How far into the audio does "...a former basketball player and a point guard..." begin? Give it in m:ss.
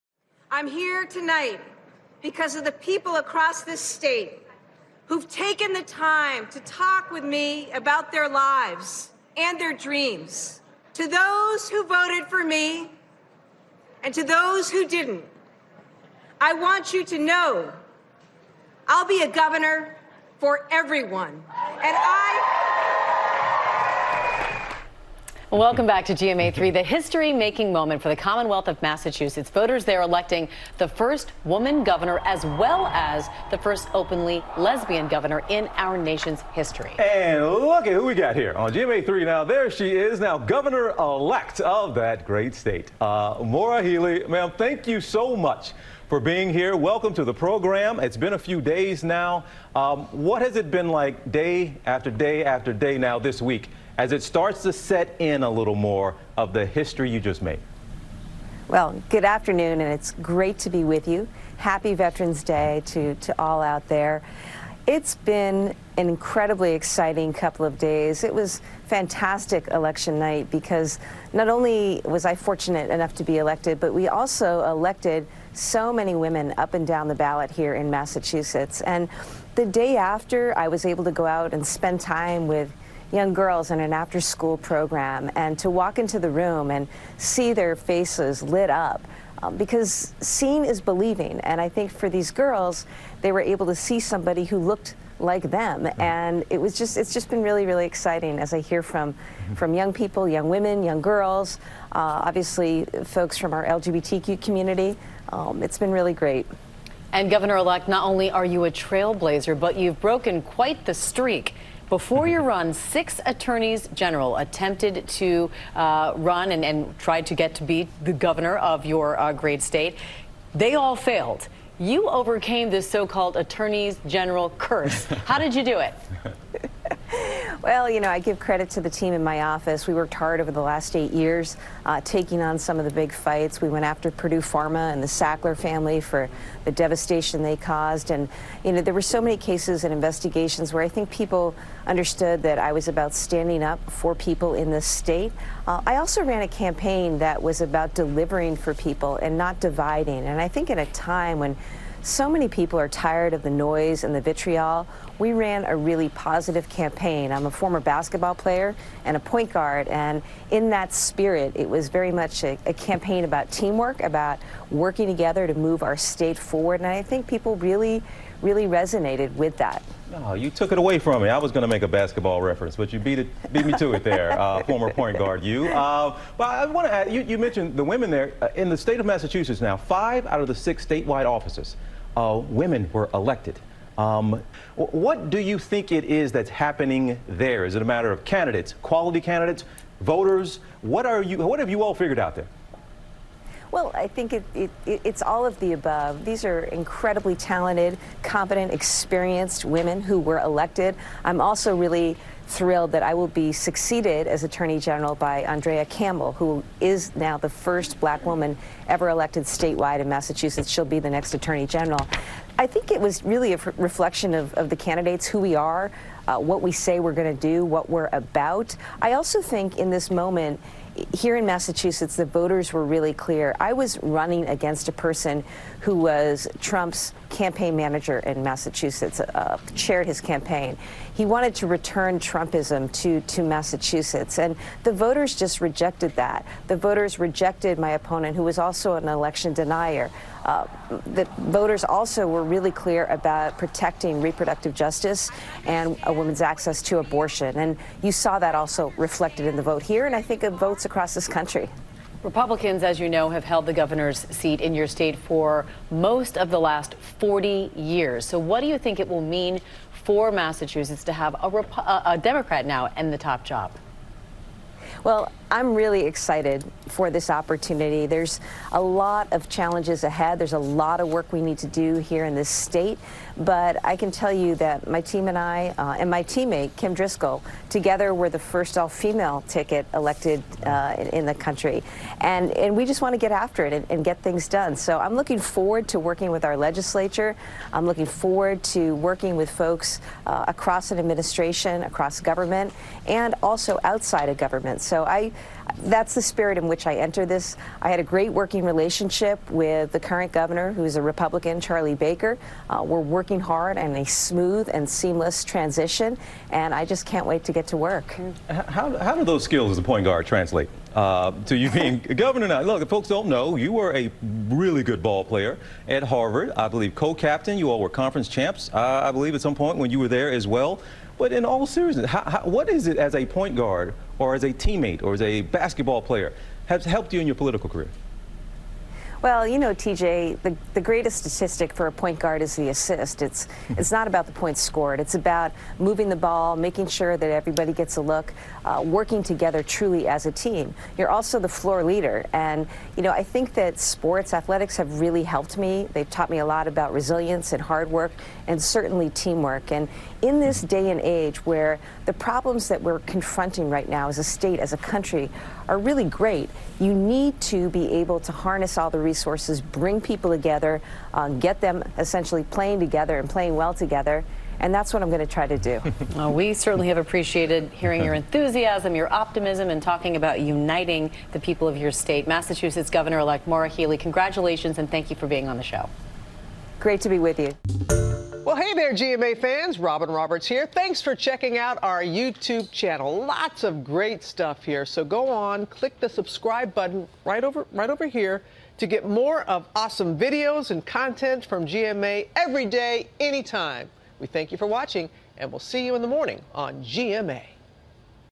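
2:37.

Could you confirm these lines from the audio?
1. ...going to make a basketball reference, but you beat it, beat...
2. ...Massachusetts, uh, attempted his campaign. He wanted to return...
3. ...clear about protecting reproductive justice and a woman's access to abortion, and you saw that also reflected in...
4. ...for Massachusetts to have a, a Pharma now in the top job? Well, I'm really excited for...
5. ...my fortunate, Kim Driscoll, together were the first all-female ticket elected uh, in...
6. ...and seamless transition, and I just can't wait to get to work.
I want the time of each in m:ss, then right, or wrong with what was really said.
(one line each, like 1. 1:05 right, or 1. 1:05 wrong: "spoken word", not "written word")
1. 2:51 right
2. 3:48 wrong: "chaired", not "attempted"
3. 4:02 right
4. 4:20 wrong: "Democrat", not "Pharma"
5. 4:36 wrong: "teammate", not "fortunate"
6. 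5:04 right.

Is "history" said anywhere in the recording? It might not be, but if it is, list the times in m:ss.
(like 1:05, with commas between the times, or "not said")
0:26, 0:36, 0:56.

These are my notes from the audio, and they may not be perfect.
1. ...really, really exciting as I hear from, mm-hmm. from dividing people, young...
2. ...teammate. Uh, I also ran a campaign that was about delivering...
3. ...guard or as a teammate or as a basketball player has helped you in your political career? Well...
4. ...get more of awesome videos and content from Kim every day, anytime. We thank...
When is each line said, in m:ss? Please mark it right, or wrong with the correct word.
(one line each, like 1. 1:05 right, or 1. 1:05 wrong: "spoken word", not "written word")
1. 1:37 wrong: "young", not "dividing"
2. 2:24 wrong: "state", not "teammate"
3. 5:23 right
4. 6:28 wrong: "GMA", not "Kim".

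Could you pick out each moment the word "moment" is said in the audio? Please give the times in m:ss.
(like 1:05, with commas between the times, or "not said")
0:27, 3:40.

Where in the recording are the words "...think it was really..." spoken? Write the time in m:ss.
3:32.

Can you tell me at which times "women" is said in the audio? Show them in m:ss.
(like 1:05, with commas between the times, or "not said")
1:16, 1:40, 2:57, 3:02, 3:19.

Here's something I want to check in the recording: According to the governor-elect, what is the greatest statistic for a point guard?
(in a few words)
The assist.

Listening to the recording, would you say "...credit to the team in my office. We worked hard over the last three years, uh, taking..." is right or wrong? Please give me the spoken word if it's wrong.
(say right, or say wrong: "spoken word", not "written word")
wrong: "eight", not "three".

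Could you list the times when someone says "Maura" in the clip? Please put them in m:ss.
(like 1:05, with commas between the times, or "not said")
0:43, 6:13.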